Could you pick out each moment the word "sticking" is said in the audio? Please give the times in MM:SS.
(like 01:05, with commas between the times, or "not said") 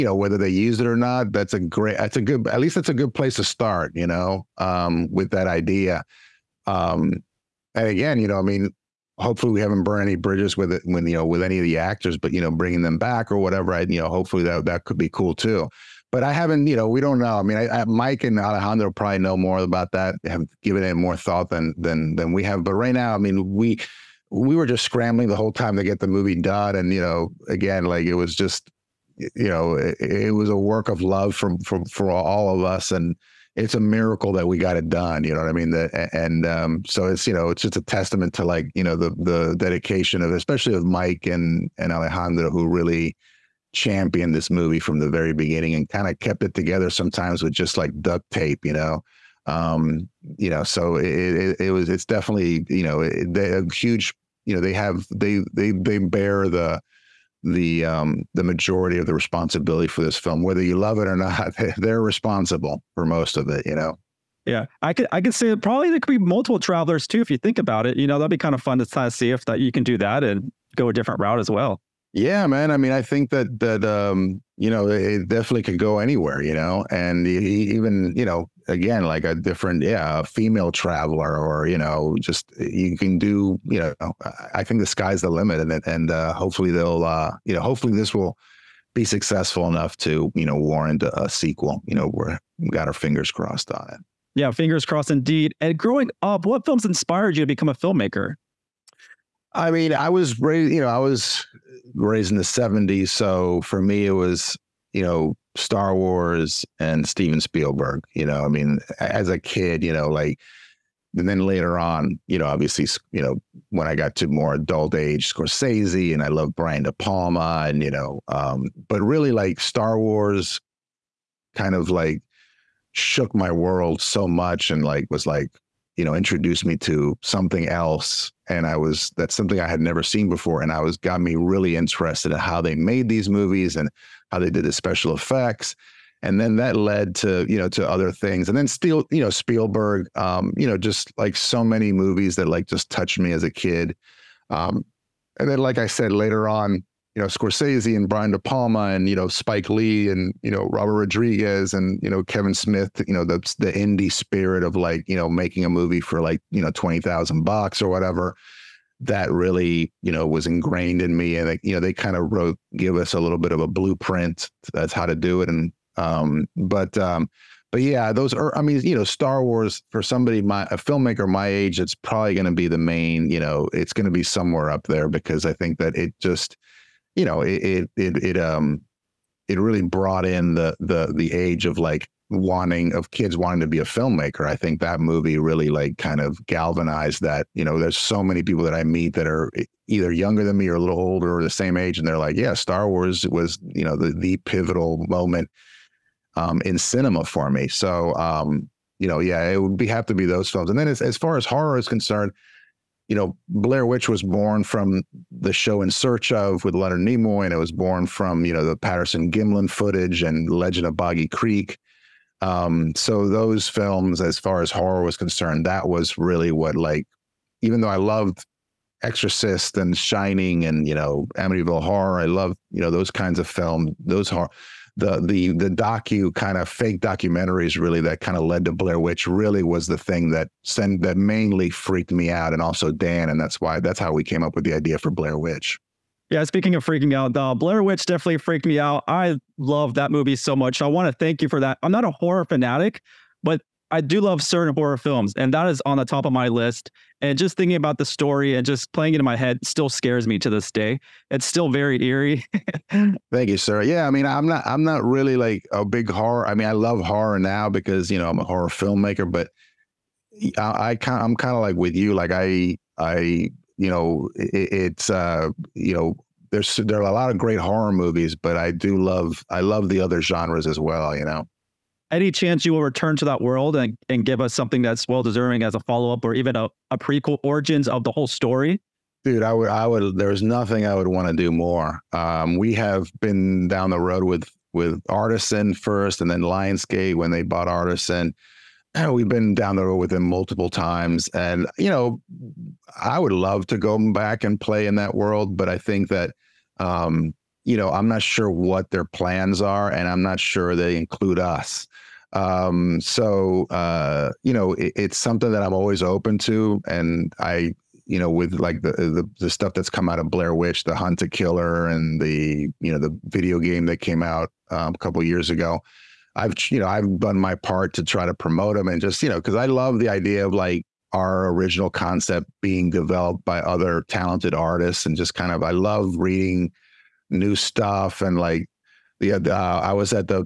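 not said.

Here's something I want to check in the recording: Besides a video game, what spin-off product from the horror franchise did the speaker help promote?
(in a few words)
Hunt a Killer.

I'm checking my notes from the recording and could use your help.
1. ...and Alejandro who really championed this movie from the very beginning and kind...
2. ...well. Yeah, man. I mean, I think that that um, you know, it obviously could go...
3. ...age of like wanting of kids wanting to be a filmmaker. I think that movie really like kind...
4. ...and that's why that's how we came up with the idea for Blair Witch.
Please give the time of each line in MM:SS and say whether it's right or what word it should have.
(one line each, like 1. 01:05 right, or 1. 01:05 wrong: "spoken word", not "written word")
1. 00:41 right
2. 01:11 wrong: "definitely", not "obviously"
3. 03:01 right
4. 03:53 right.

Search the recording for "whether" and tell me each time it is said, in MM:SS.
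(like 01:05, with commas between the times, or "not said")
00:00, 01:00.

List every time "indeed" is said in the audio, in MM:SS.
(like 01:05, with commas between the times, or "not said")
01:35.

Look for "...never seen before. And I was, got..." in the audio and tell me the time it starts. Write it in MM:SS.
02:09.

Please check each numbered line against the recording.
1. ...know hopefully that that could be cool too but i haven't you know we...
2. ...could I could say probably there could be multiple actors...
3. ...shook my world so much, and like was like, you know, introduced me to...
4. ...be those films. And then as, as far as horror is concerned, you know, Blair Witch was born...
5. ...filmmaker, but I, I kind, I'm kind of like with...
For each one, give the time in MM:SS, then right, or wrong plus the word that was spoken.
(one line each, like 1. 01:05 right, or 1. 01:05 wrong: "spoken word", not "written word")
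1. 00:14 right
2. 01:04 wrong: "travelers", not "actors"
3. 02:02 right
4. 03:20 right
5. 04:18 right.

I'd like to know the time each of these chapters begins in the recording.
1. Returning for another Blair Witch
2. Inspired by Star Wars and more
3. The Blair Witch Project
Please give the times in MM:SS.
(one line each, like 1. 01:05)
1. 03:57
2. 01:36
3. 03:21.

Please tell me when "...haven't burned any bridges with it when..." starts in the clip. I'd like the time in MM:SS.
00:09.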